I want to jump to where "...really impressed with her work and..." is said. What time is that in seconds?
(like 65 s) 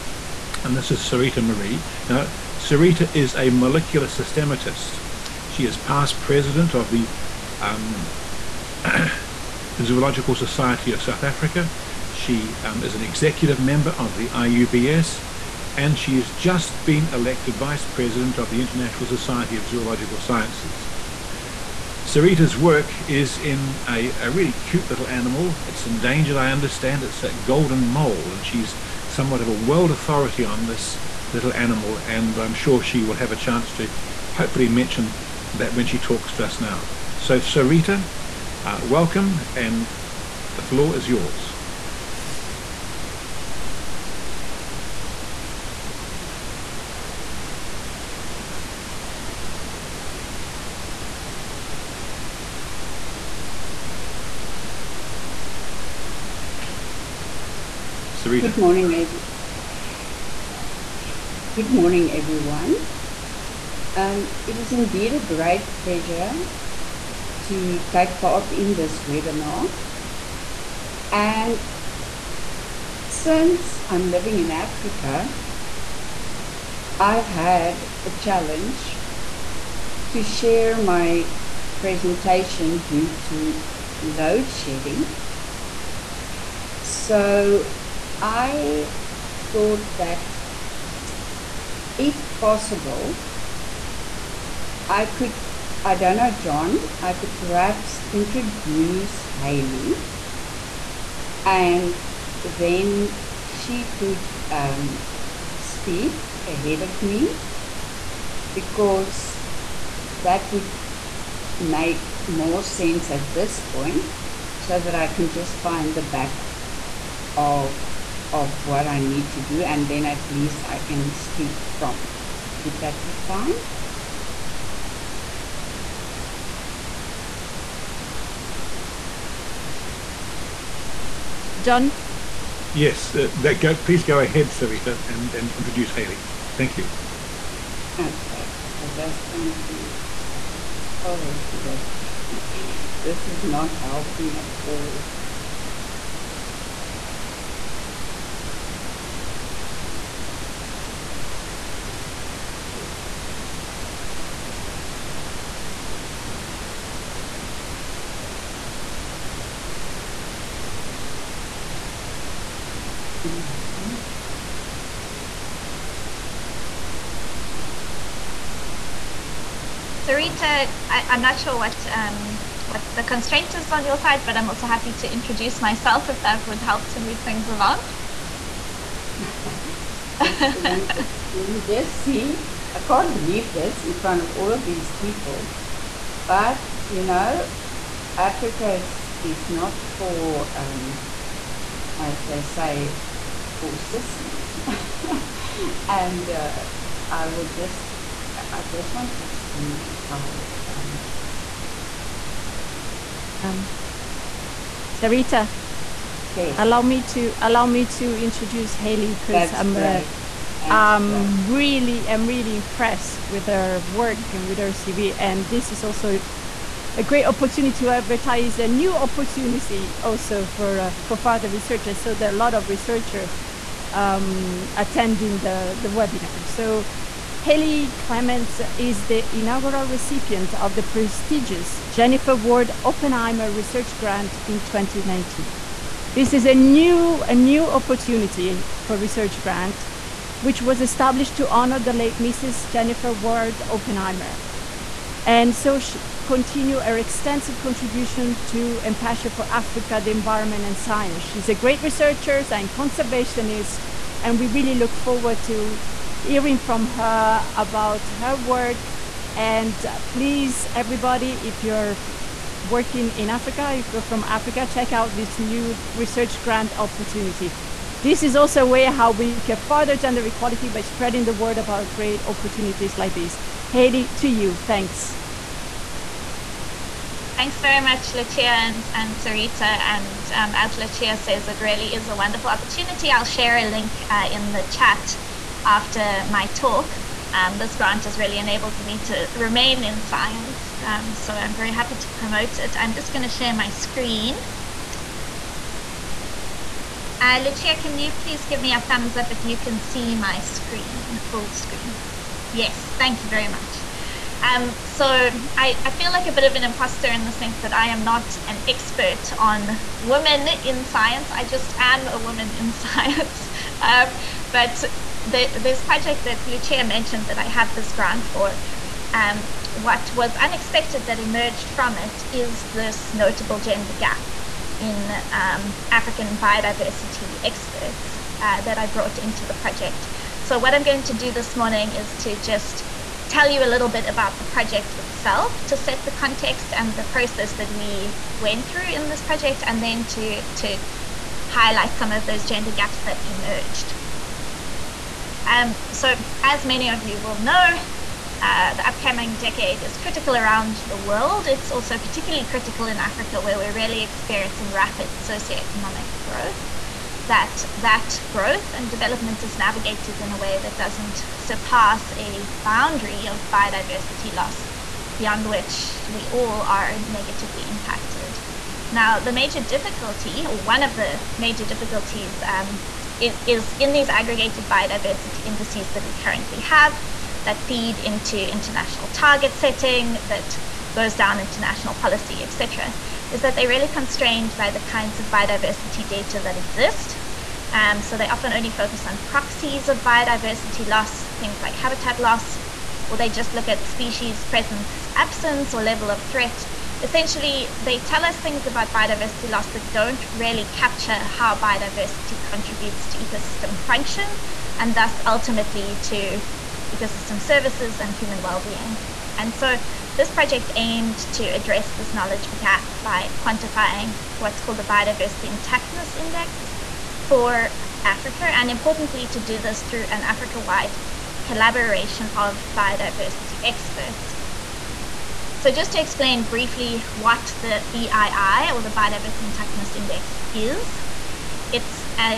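212 s.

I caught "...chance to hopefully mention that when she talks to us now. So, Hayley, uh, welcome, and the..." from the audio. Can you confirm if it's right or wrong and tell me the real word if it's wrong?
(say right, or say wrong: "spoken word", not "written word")
wrong: "Sarita", not "Hayley".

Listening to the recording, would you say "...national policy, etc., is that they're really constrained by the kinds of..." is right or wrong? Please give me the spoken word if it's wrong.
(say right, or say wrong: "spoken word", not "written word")
right.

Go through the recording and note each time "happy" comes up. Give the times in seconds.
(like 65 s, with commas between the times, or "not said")
174 s, 291 s.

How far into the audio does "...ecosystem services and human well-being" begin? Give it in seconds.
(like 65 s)
406 s.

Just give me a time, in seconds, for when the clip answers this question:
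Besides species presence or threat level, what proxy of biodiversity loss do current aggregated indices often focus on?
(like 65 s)
391 s.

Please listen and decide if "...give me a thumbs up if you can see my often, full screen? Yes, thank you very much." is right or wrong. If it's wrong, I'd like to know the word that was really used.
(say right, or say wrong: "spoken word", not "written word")
wrong: "screen", not "often".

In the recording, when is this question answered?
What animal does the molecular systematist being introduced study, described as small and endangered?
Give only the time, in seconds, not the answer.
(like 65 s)
27 s.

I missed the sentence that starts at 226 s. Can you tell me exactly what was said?
So Hayley Clements is the inaugural recipient of the prestigious Jennifer Ward Oppenheimer Research Grant in 2019.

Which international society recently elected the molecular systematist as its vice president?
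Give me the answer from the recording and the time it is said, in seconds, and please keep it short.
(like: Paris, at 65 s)
International Society of Zoological Sciences, at 18 s.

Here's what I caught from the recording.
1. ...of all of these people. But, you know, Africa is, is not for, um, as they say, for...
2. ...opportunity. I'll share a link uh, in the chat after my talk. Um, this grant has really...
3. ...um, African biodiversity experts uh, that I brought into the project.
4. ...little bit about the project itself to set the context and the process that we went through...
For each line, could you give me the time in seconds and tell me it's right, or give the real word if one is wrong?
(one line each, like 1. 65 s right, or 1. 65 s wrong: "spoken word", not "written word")
1. 184 s right
2. 282 s right
3. 325 s right
4. 333 s right.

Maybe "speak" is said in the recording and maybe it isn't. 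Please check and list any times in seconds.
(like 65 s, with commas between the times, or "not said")
105 s, 121 s.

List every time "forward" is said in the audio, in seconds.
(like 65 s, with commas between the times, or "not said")
254 s.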